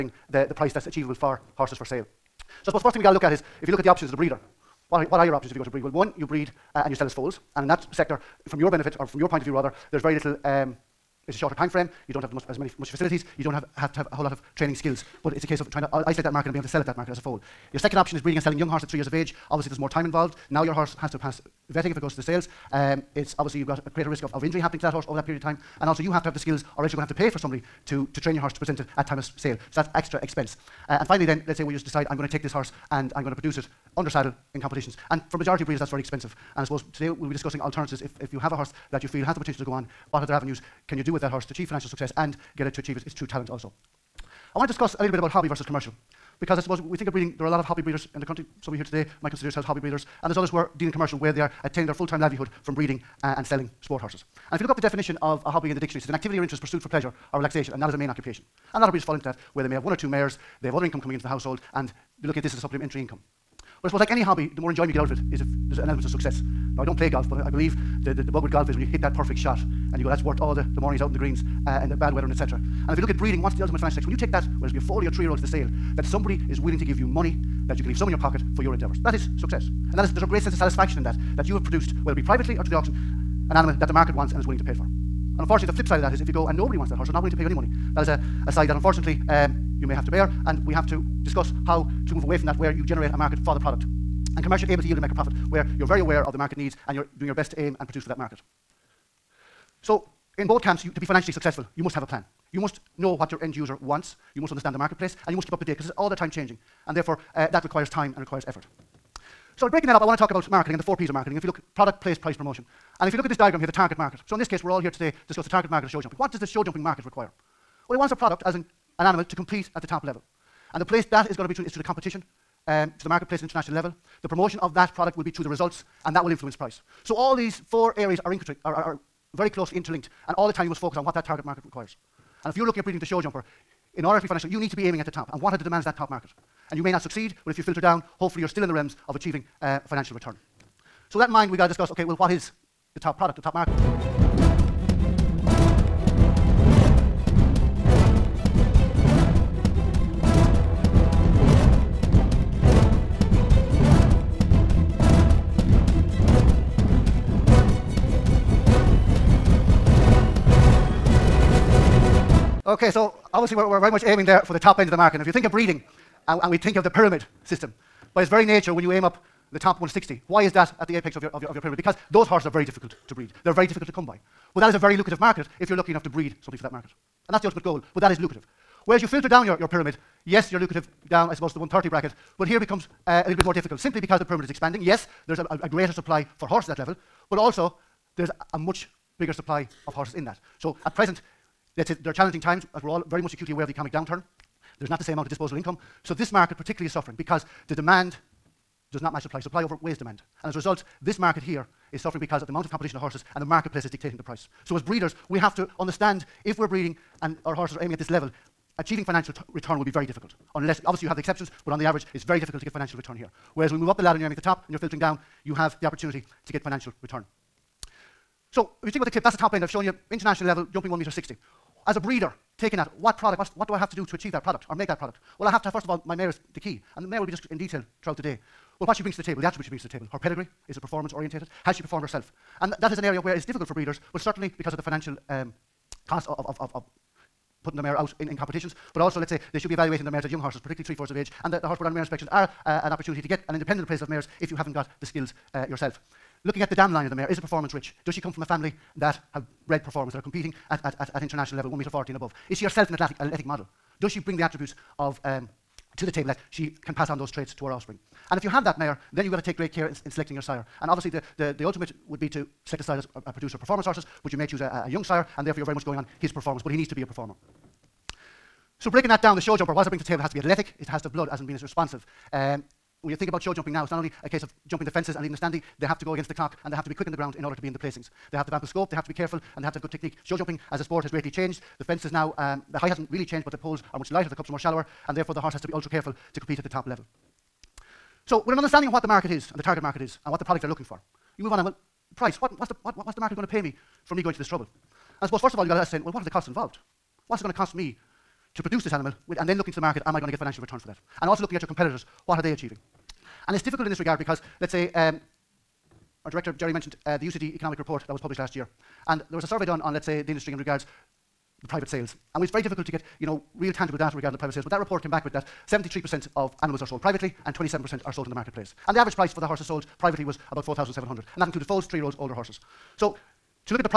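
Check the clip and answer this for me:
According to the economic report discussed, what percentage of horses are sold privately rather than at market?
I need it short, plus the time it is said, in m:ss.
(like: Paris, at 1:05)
73%, at 5:15.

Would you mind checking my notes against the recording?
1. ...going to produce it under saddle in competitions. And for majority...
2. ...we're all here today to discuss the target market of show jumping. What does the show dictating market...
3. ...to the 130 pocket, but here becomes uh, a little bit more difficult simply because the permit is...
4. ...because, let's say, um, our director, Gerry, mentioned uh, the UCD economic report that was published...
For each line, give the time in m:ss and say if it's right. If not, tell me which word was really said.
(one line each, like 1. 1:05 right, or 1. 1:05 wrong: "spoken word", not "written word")
1. 0:33 right
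2. 1:54 wrong: "jumping", not "dictating"
3. 3:01 wrong: "bracket", not "pocket"
4. 5:04 right.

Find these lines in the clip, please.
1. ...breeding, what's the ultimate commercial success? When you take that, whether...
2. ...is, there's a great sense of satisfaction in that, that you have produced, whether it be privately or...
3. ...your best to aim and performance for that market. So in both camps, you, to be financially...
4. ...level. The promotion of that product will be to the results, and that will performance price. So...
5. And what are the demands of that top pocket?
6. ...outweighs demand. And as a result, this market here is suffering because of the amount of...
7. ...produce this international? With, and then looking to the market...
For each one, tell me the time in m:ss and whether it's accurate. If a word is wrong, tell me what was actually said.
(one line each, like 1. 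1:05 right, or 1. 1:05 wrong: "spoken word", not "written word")
1. 1:13 wrong: "financial", not "commercial"
2. 1:20 right
3. 1:37 wrong: "produce", not "performance"
4. 2:03 wrong: "influence", not "performance"
5. 2:15 wrong: "market", not "pocket"
6. 3:19 right
7. 4:58 wrong: "animal", not "international".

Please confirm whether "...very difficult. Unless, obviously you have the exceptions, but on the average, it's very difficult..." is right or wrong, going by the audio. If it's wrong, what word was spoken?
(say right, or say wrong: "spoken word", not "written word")
right.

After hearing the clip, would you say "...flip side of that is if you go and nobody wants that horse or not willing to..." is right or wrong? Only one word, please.
right.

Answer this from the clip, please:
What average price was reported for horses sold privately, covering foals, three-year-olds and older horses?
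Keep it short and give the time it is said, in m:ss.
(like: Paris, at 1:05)
4,700, at 5:20.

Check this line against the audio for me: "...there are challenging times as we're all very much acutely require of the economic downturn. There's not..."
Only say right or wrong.
wrong.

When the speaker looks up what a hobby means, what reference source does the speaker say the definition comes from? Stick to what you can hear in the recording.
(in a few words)
The dictionary.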